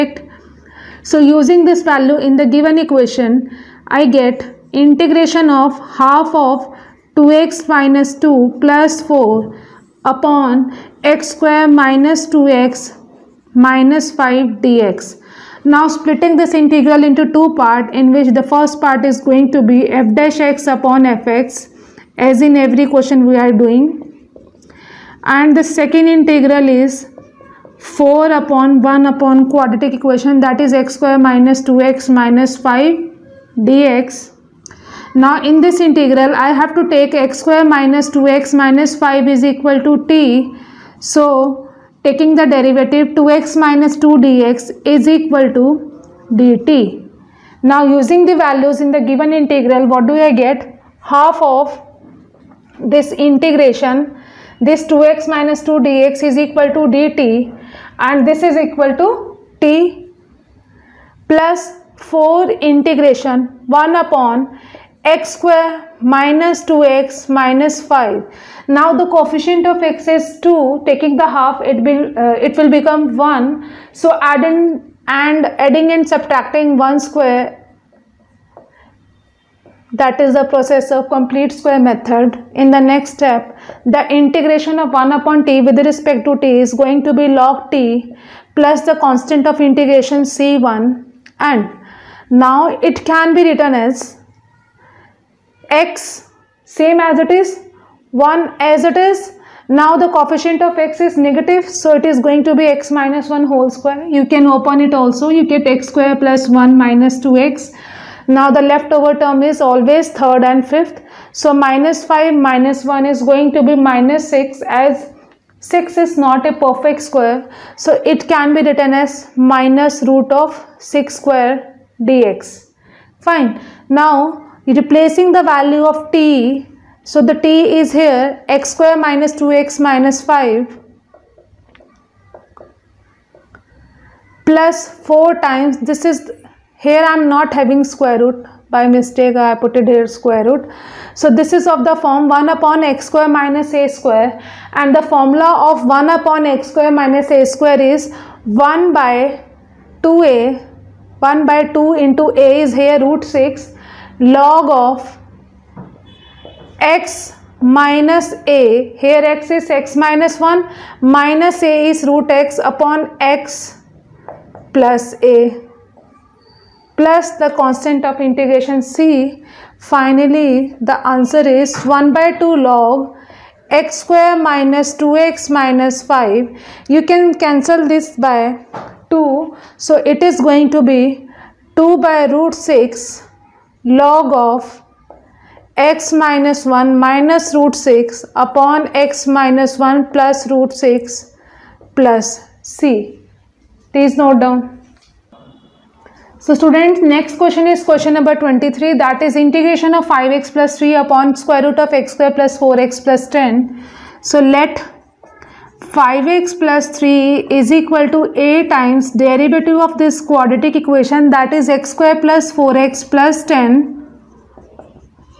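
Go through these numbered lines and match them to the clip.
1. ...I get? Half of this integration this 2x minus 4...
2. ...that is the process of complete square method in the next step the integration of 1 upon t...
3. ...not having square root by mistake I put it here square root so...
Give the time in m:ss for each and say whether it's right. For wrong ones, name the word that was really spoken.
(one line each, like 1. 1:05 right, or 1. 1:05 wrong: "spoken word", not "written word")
1. 0:50 wrong: "2", not "4"
2. 1:19 right
3. 2:17 right.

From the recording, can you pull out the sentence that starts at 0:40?
So taking the derivative 2x minus 2 dx is equal to dt.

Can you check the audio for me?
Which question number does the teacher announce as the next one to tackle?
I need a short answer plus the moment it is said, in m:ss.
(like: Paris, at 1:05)
23, at 3:18.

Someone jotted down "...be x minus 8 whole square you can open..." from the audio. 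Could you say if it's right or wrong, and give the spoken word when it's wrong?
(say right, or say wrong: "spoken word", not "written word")
wrong: "1", not "8".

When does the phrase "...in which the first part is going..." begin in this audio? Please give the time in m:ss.
0:17.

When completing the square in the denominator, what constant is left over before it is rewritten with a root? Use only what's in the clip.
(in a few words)
-6.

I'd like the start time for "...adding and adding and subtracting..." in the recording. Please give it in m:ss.
1:14.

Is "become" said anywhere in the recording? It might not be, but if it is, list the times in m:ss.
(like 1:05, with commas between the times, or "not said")
1:12.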